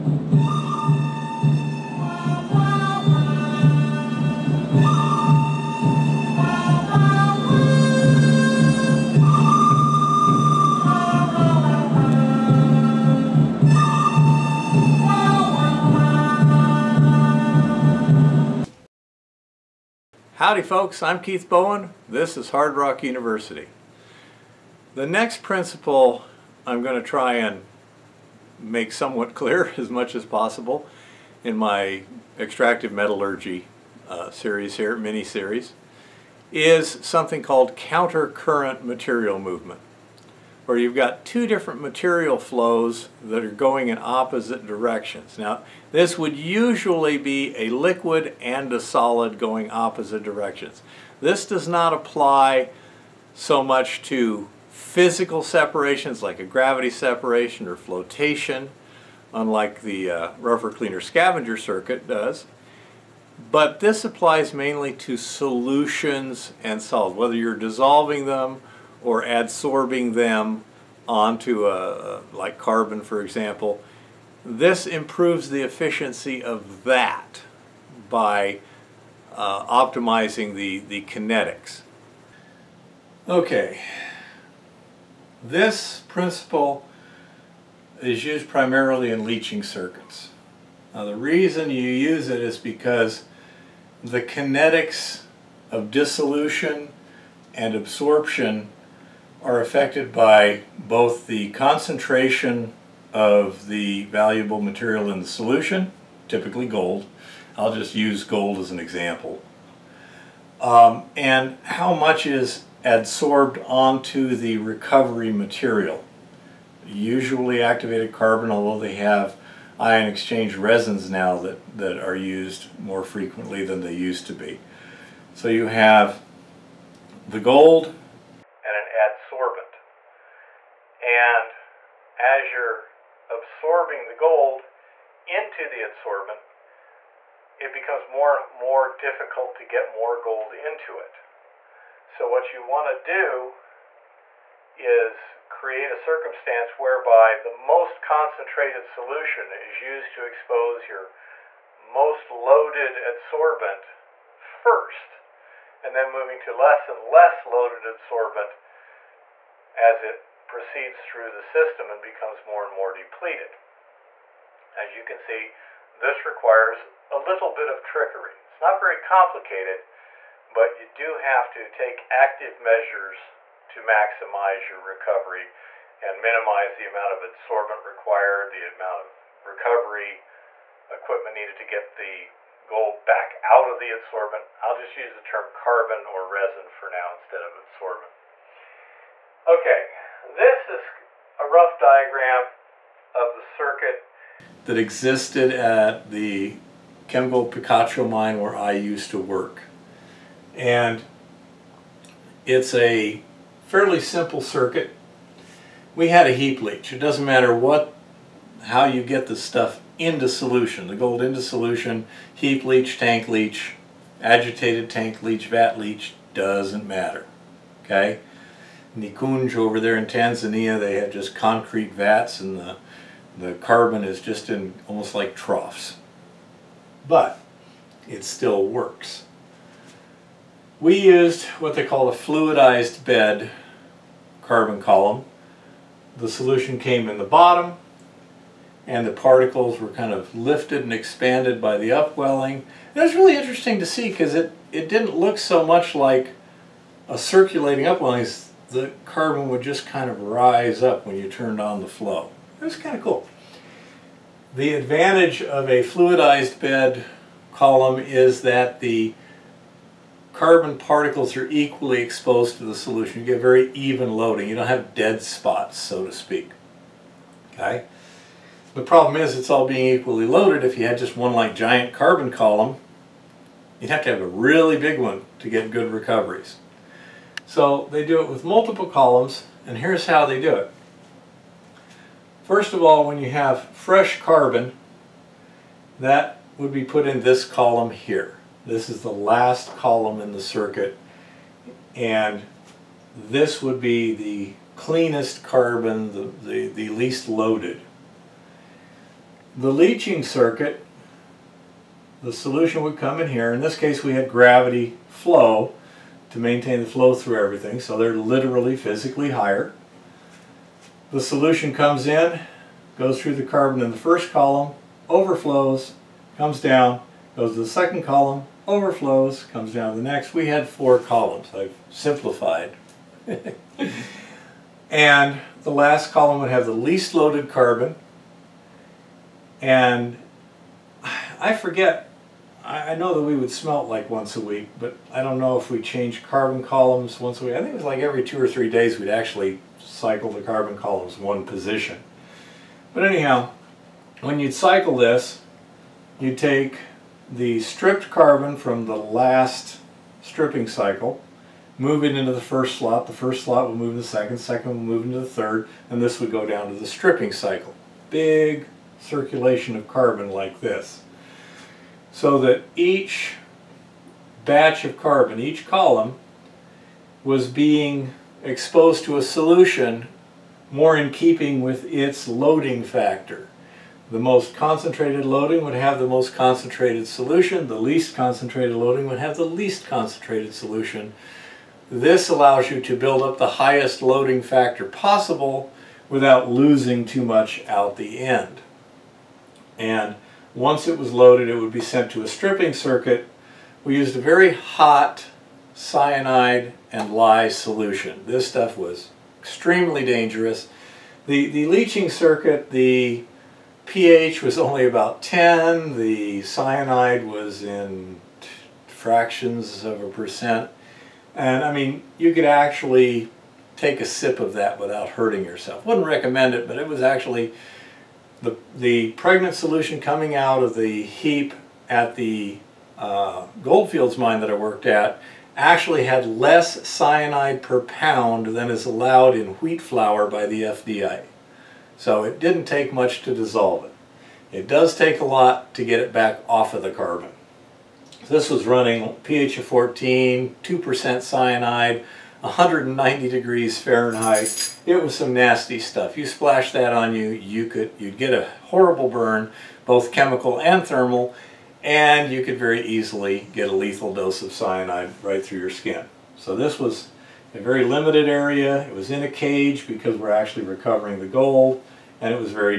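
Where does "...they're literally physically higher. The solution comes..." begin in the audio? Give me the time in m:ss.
5:07.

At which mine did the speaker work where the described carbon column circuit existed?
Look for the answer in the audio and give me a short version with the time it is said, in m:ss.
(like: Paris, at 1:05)
Chemgold Picacho mine, at 3:17.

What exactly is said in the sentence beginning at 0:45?
Now, this would usually be a liquid and a solid going opposite directions.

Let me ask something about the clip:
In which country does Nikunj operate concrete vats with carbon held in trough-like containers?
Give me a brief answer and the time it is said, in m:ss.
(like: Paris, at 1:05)
Tanzania, at 3:40.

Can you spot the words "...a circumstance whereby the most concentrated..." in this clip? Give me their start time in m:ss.
2:25.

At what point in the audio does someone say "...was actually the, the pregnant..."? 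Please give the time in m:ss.
6:56.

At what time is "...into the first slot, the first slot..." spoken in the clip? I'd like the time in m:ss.
5:52.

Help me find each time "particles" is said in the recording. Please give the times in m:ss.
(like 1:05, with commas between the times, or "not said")
3:59, 4:20.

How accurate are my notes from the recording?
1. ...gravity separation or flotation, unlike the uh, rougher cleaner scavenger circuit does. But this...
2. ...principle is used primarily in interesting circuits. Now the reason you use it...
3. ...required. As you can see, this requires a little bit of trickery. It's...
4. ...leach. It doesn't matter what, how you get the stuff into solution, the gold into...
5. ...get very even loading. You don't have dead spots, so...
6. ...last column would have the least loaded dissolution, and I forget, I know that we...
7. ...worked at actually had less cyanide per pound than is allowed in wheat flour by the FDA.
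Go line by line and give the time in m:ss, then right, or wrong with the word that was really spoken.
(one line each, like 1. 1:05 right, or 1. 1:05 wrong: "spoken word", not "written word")
1. 0:56 right
2. 1:26 wrong: "leaching", not "interesting"
3. 2:42 wrong: "depleted", not "required"
4. 3:26 right
5. 4:23 right
6. 5:25 wrong: "carbon", not "dissolution"
7. 7:04 right.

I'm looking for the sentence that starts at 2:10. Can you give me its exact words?
And as you're absorbing the gold into the adsorbent, it becomes more and more difficult to get more gold into it.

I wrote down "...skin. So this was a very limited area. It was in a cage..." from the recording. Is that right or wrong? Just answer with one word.
right.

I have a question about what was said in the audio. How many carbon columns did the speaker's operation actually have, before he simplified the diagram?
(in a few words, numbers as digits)
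4.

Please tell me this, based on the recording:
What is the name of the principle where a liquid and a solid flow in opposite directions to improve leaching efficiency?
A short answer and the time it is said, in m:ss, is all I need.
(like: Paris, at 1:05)
Counter-current material movement, at 0:37.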